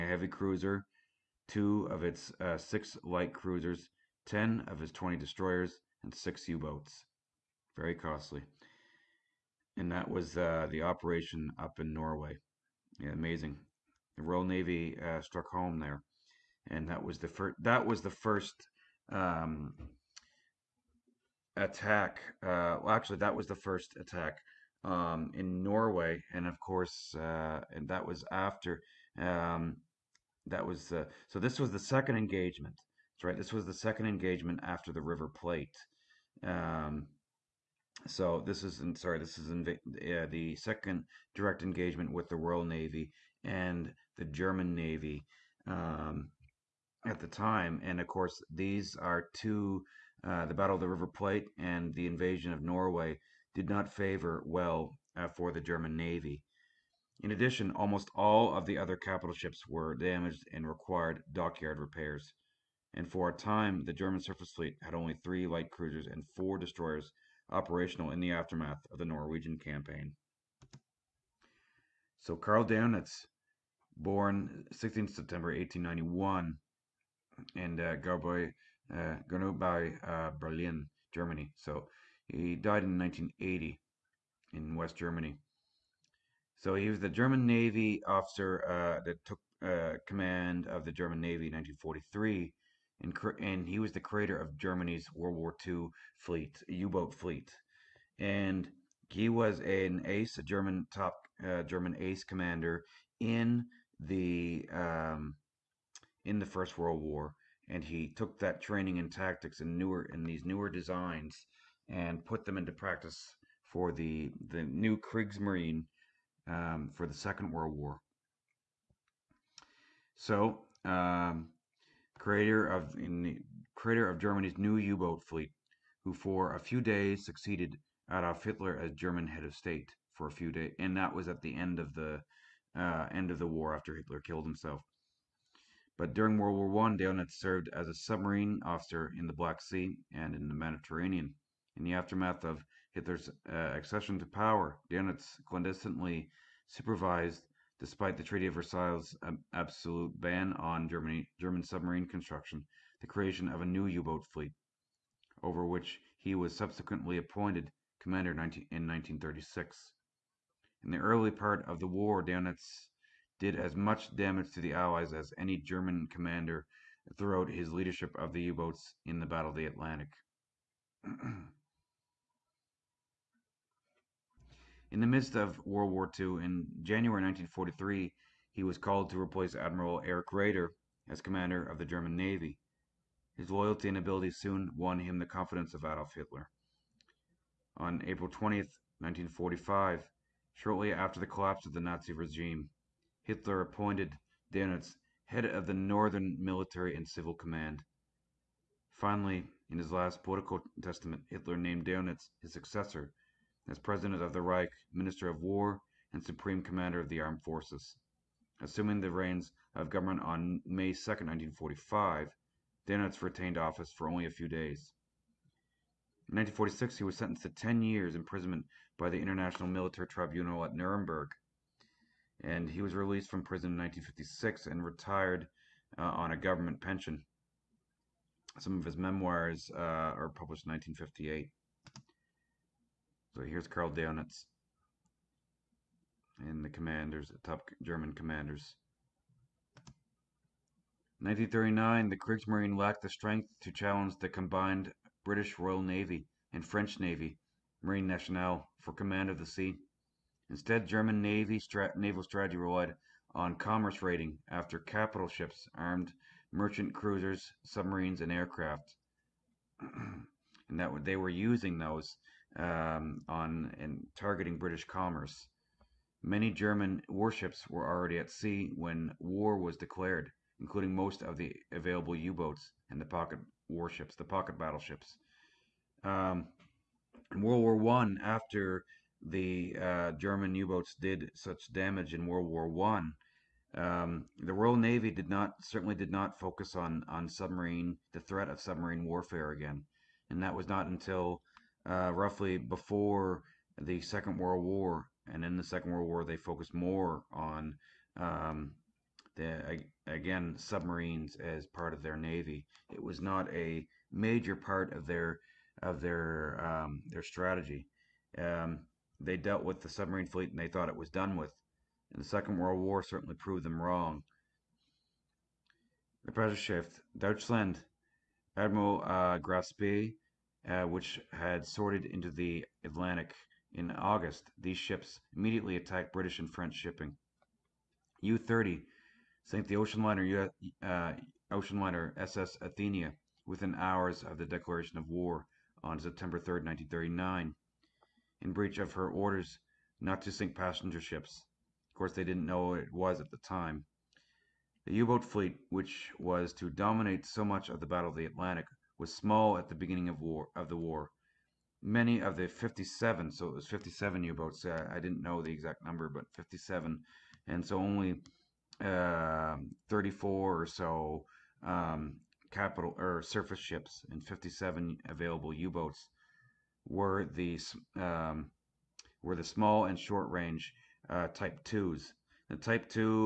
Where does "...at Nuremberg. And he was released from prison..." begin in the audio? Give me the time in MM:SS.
03:40.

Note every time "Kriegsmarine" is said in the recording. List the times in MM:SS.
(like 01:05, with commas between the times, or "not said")
01:54, 04:02.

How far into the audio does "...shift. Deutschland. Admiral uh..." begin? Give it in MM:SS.
05:16.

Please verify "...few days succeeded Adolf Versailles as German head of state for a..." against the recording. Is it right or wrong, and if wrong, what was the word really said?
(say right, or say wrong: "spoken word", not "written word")
wrong: "Hitler", not "Versailles".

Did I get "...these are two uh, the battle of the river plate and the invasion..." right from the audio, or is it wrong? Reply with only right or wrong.
right.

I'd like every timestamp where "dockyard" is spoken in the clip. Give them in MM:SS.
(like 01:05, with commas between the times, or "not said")
01:01.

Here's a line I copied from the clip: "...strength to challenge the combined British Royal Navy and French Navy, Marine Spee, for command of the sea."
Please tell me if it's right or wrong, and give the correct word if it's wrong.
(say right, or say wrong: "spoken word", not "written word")
wrong: "Nationale", not "Spee".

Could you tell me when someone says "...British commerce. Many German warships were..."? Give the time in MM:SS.
04:24.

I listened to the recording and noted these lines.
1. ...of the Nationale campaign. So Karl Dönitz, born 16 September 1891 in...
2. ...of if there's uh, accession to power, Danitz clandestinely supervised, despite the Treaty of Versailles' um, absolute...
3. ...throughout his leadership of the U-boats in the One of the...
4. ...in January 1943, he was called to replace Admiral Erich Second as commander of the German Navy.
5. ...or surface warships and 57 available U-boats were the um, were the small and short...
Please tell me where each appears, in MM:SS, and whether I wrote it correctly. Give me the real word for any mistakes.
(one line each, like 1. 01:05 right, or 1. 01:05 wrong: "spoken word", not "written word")
1. 01:08 wrong: "Norwegian", not "Nationale"
2. 02:22 right
3. 02:47 wrong: "Battle", not "One"
4. 02:56 wrong: "Raeder", not "Second"
5. 06:02 wrong: "ships", not "warships".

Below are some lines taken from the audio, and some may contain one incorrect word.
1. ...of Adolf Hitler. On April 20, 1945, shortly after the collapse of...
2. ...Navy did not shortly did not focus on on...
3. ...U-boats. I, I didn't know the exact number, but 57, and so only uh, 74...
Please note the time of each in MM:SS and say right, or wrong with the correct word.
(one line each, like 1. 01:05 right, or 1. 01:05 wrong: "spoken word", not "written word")
1. 03:05 right
2. 04:44 wrong: "certainly", not "shortly"
3. 05:54 wrong: "34", not "74".